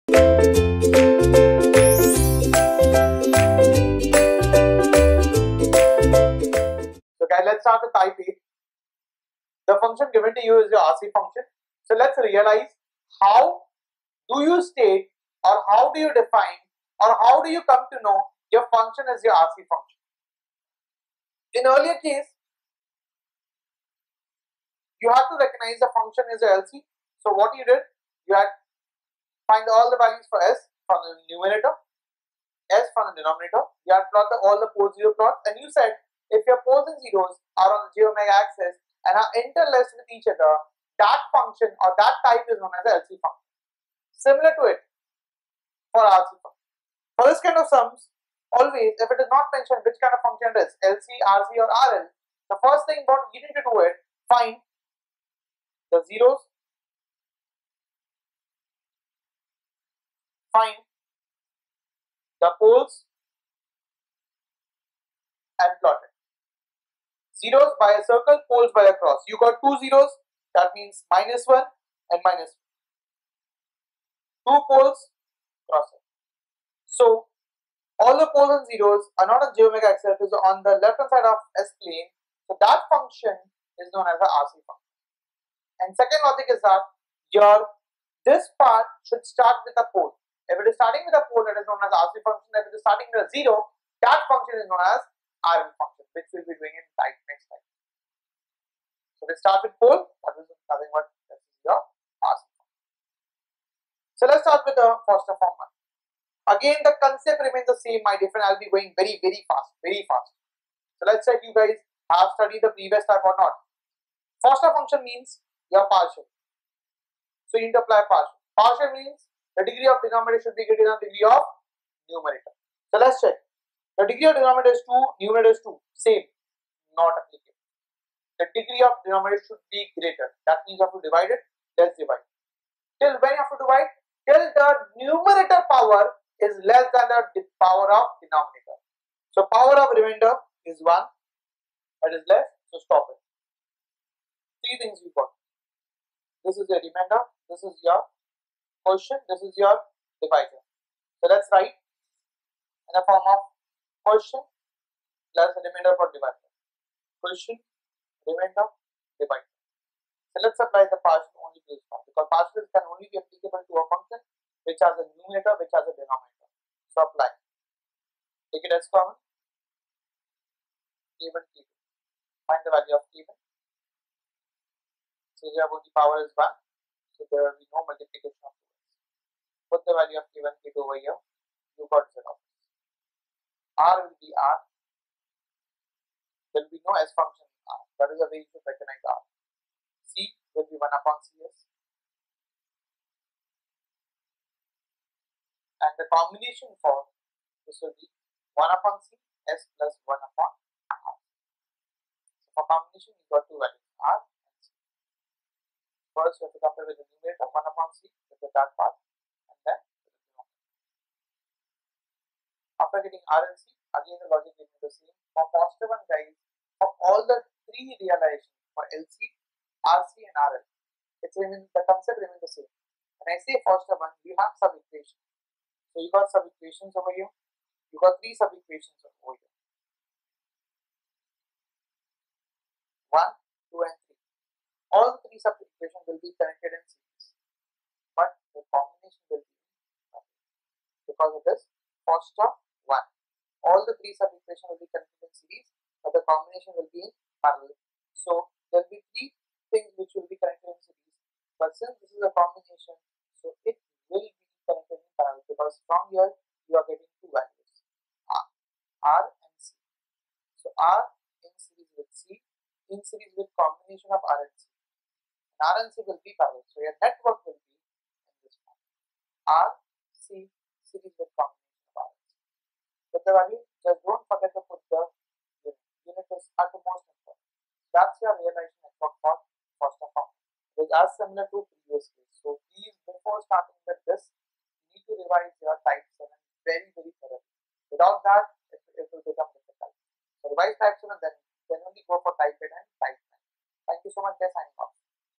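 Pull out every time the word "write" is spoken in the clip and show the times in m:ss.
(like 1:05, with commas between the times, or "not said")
2:31.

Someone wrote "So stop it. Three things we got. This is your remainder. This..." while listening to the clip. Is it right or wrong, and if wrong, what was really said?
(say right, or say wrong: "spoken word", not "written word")
right.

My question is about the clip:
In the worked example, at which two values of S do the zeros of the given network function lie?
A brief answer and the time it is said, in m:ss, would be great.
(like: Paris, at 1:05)
-1 and -2, at 1:11.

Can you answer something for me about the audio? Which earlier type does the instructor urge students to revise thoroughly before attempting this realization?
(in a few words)
Type 7.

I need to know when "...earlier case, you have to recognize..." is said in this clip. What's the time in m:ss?
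0:21.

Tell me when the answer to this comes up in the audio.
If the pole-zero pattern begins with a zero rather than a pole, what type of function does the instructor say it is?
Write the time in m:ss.
1:35.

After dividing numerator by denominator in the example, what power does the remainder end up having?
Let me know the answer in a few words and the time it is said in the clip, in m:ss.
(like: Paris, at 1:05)
1, at 2:19.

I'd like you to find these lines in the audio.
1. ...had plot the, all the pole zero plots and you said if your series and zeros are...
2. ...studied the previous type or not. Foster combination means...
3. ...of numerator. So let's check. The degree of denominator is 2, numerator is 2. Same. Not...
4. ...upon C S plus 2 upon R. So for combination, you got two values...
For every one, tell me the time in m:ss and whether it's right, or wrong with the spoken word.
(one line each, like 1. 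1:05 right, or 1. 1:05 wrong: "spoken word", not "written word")
1. 0:33 wrong: "poles", not "series"
2. 1:52 wrong: "function", not "combination"
3. 2:01 right
4. 3:18 wrong: "1", not "2".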